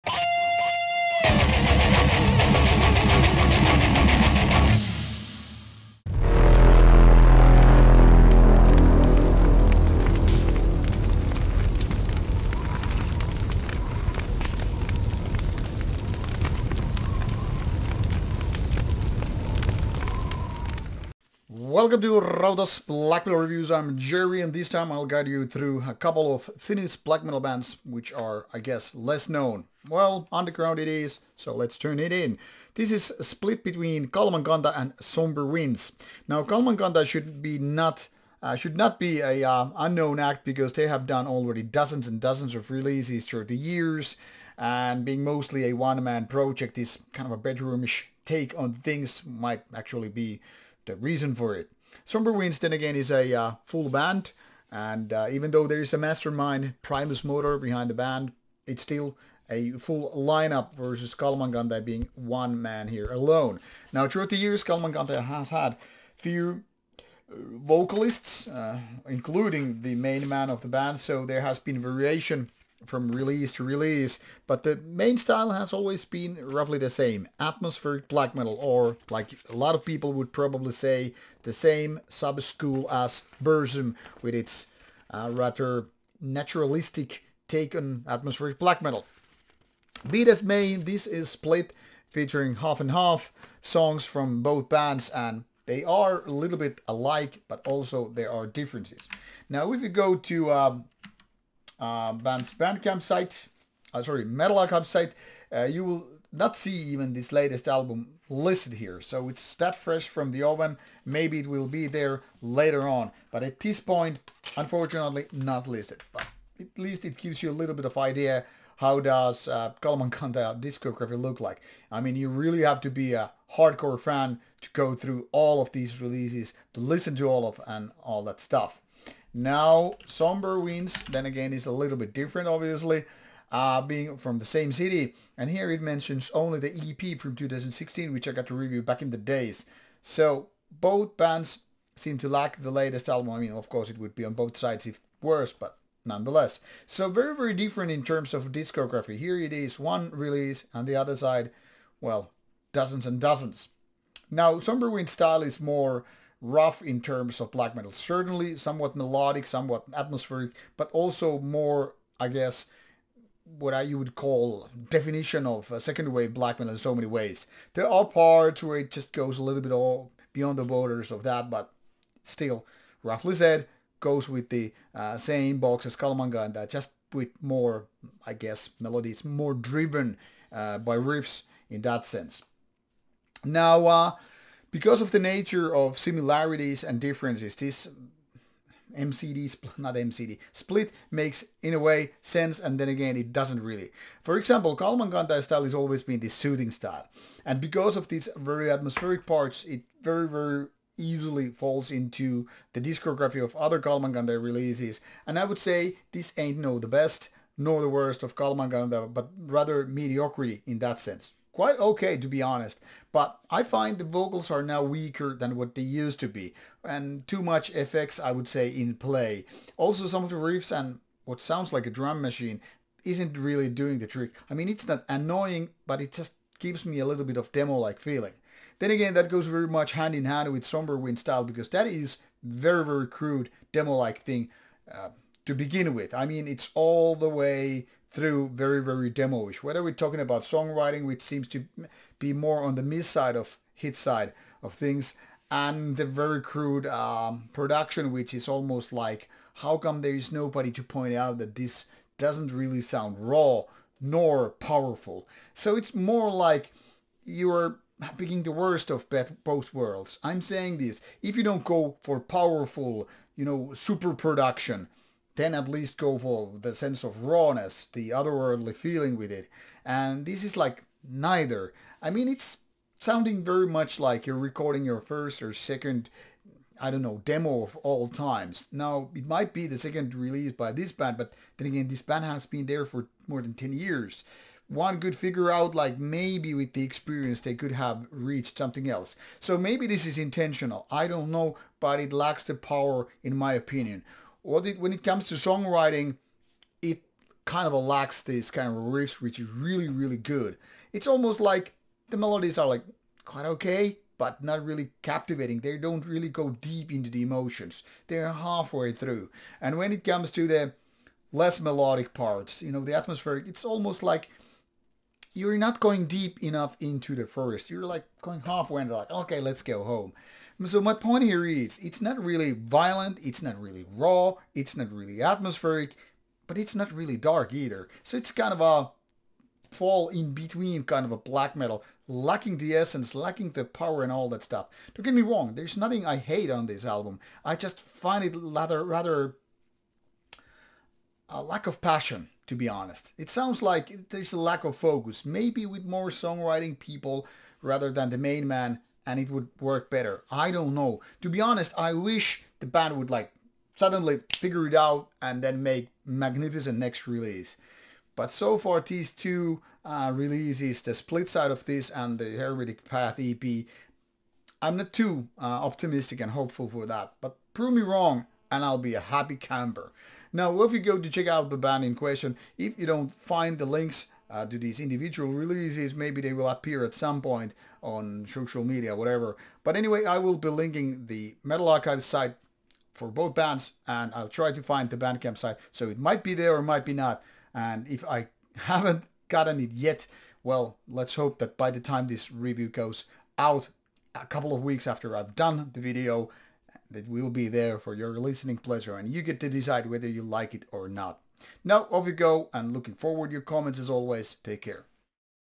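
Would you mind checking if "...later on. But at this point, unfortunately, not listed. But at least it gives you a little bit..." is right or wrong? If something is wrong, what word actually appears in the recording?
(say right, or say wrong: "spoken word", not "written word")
right.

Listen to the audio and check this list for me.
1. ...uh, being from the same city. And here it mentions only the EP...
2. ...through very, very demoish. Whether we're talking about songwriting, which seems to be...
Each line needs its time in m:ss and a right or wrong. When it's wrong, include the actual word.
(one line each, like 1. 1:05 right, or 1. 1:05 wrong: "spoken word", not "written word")
1. 2:13 right
2. 3:58 right.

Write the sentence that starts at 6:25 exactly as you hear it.
So it might be there or might be not.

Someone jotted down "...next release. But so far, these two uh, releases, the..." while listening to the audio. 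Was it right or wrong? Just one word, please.
right.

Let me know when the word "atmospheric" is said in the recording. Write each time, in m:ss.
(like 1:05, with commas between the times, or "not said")
1:17, 1:28, 2:39, 3:18, 5:12, 5:25.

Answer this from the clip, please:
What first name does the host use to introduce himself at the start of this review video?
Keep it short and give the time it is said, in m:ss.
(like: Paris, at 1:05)
Jerry, at 0:23.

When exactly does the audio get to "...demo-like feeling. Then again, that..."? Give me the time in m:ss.
3:47.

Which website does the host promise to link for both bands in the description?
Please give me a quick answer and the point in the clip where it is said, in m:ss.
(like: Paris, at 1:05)
Metal Archive, at 6:21.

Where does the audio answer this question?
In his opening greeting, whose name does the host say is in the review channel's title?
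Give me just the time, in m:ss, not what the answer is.
0:22.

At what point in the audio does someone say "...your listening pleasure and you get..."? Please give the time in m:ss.
6:37.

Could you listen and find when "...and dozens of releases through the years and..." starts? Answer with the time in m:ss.
0:42.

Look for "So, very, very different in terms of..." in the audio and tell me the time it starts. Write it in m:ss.
2:26.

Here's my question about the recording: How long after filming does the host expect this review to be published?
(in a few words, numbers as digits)
a couple of weeks.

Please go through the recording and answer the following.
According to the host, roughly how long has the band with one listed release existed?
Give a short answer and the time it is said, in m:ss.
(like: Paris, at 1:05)
more than 10 years, at 4:43.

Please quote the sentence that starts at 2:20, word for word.
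So, both bands seem to lack the latest album.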